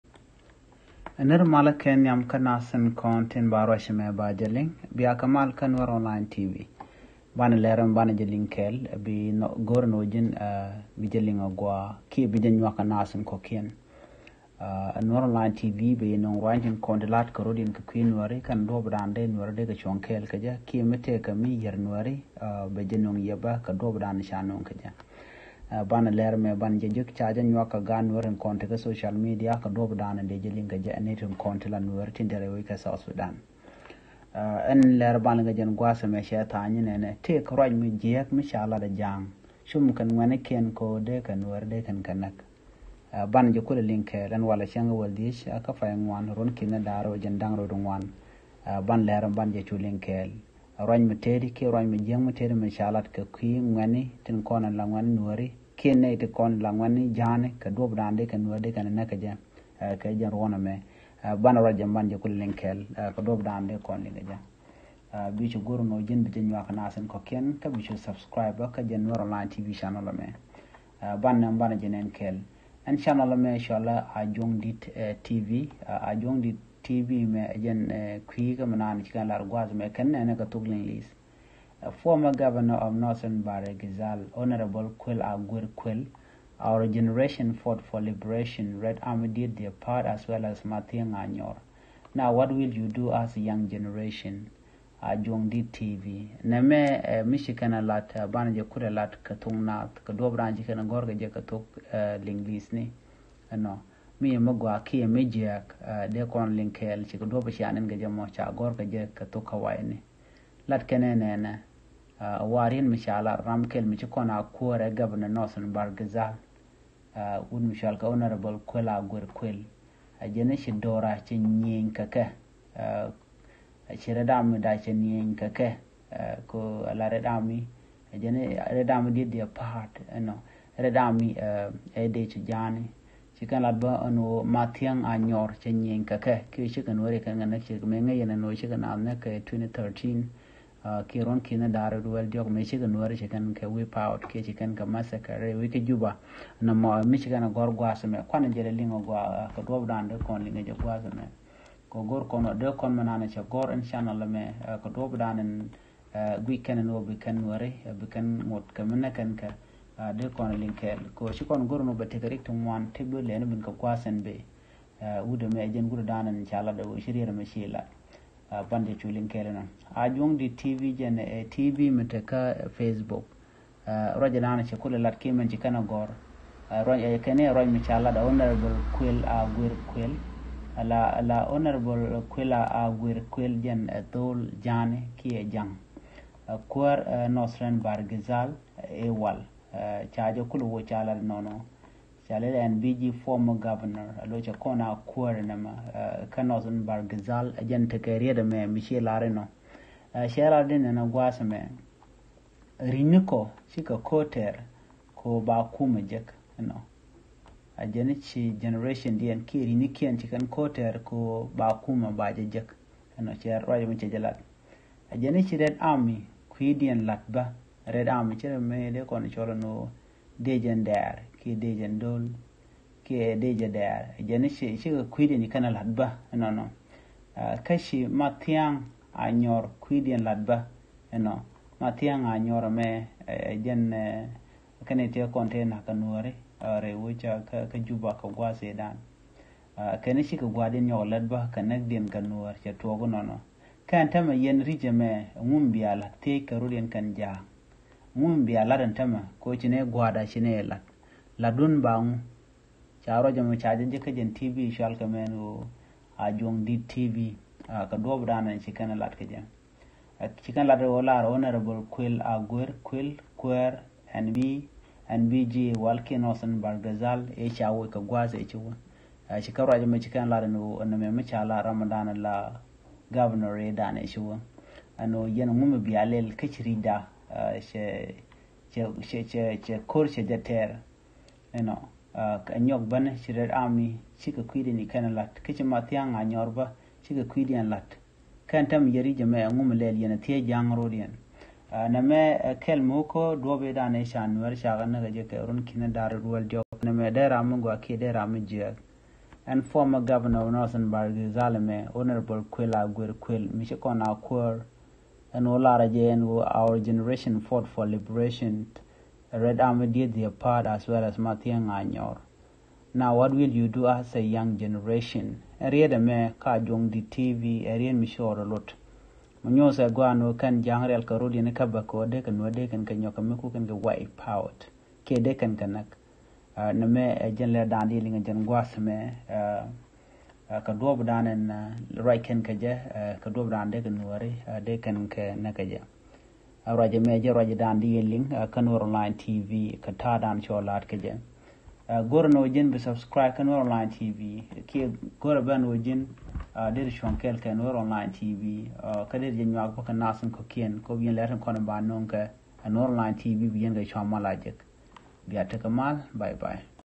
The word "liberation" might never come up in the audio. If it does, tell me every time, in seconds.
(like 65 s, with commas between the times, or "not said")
87 s, 307 s.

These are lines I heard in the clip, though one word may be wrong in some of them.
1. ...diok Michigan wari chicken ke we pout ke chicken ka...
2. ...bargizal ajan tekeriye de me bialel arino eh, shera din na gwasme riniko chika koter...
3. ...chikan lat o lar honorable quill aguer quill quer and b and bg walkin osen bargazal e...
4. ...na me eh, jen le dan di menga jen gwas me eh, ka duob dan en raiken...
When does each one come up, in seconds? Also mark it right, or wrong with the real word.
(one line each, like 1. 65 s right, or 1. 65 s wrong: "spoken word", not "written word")
1. 142 s right
2. 196 s wrong: "michel", not "bialel"
3. 260 s right
4. 326 s wrong: "linga", not "menga".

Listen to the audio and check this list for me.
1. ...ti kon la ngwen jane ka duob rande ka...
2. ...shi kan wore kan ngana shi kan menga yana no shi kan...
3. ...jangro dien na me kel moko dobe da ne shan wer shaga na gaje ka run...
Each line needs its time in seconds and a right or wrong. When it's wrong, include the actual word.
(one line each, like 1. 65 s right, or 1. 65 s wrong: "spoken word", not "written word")
1. 56 s right
2. 136 s right
3. 290 s right.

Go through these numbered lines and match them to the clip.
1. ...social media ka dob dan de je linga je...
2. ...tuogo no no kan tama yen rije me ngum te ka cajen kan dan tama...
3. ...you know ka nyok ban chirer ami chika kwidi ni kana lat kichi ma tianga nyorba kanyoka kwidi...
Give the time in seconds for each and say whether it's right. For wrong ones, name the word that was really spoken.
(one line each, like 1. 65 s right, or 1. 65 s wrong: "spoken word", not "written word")
1. 28 s right
2. 242 s wrong: "ruden", not "cajen"
3. 281 s wrong: "chika", not "kanyoka".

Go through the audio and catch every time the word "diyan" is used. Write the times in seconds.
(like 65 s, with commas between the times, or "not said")
209 s, 216 s.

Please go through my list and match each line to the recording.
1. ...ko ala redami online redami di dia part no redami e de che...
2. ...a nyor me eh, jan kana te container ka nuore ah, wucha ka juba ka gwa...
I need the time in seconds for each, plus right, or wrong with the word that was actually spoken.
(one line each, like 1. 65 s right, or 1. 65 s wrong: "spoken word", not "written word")
1. 126 s wrong: "ajene", not "online"
2. 232 s right.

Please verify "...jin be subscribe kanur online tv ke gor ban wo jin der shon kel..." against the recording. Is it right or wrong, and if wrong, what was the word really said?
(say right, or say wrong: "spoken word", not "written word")
right.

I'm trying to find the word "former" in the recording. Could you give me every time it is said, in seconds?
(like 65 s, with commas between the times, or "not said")
81 s, 193 s, 299 s.